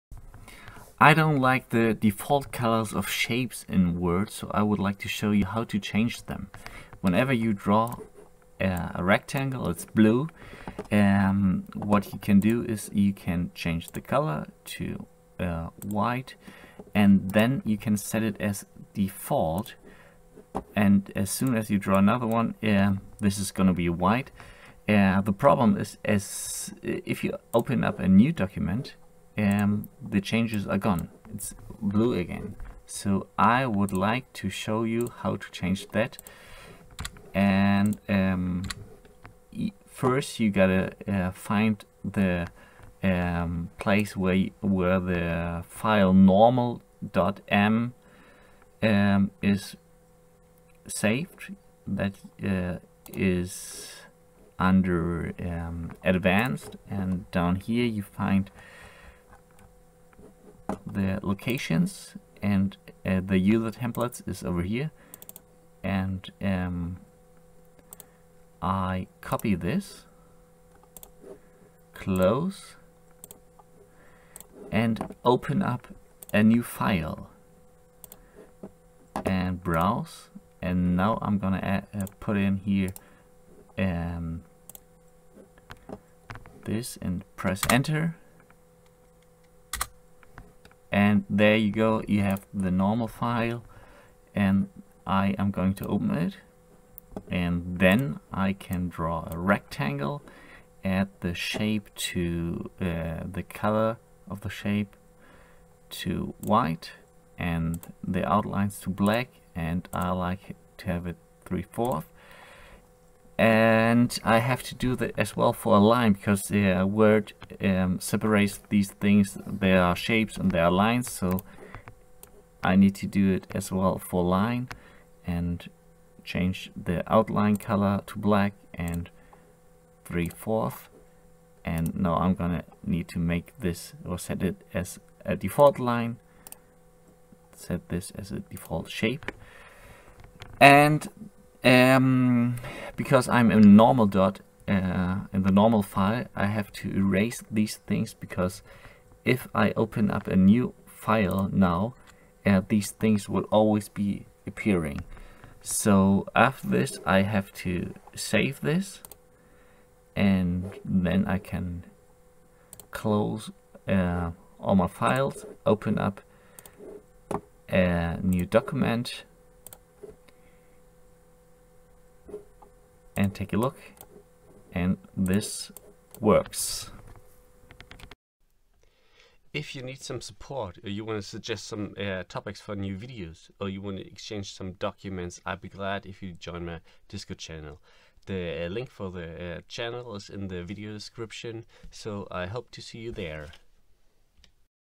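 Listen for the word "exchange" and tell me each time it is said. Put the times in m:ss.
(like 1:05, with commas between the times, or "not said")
3:04.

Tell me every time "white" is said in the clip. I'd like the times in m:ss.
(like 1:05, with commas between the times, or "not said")
0:15, 0:23, 1:46.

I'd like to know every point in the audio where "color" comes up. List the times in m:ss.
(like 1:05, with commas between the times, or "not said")
0:02, 0:14, 1:43, 2:07.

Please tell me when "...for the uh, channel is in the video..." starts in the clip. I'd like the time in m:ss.
3:08.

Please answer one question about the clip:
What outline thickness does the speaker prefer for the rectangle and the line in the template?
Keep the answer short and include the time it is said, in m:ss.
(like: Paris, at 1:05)
3/4, at 1:51.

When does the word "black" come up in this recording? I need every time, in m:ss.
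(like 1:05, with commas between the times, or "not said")
1:48, 2:08.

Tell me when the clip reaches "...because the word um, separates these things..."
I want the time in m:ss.
1:56.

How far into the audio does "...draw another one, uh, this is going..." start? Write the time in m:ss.
0:21.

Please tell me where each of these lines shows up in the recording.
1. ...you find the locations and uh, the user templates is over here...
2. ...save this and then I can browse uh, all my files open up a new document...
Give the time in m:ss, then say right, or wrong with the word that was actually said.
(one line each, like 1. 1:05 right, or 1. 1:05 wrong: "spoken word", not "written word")
1. 0:57 right
2. 2:38 wrong: "close", not "browse".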